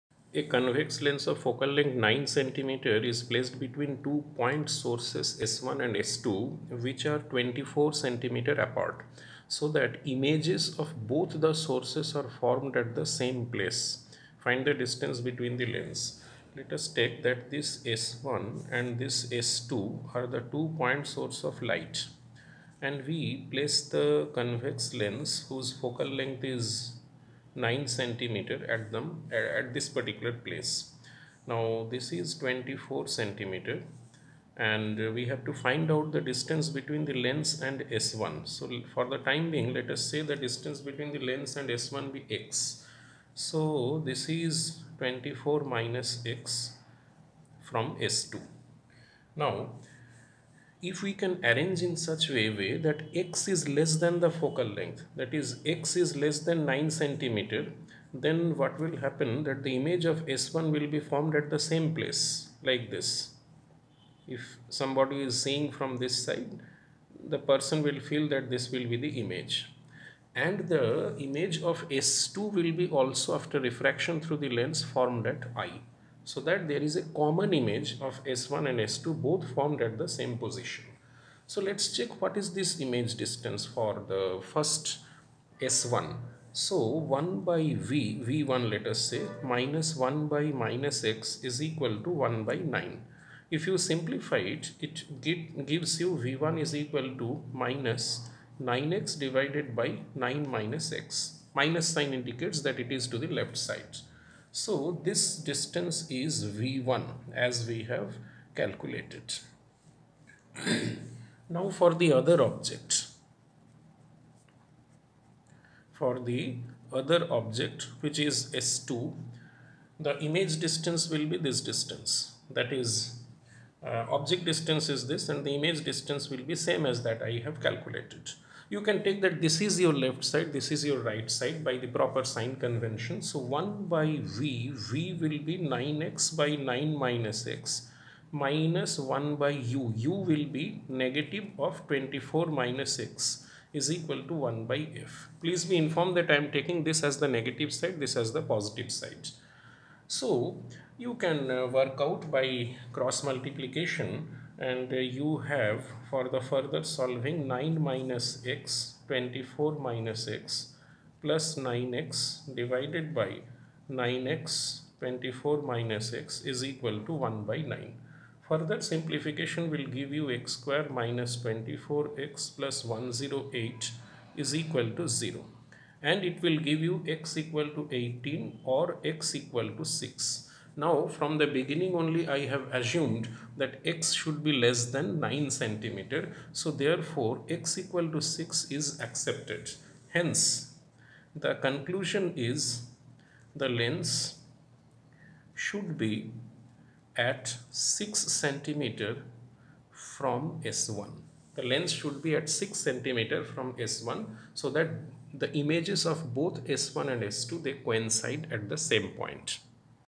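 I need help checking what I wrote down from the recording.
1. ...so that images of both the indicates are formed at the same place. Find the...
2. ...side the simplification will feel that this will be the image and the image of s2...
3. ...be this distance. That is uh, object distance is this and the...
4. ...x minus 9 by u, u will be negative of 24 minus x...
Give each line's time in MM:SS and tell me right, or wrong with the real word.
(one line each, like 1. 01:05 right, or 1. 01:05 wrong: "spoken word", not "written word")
1. 00:09 wrong: "sources", not "indicates"
2. 01:06 wrong: "person", not "simplification"
3. 02:01 right
4. 02:17 wrong: "1", not "9".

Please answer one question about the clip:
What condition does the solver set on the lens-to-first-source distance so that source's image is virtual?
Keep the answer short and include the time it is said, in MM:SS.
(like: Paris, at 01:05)
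less than 9 cm, at 00:55.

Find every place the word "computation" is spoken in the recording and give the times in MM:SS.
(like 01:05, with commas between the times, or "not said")
not said.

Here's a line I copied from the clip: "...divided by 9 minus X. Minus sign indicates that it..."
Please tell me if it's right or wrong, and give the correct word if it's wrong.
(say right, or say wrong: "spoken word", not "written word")
right.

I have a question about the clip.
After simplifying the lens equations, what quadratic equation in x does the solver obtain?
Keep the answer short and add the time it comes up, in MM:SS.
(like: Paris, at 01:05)
x² - 24x + 108 = 0, at 02:50.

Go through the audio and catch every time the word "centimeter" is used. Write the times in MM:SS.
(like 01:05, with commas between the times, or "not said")
00:27, 00:33, 00:56, 03:05, 03:18, 03:22.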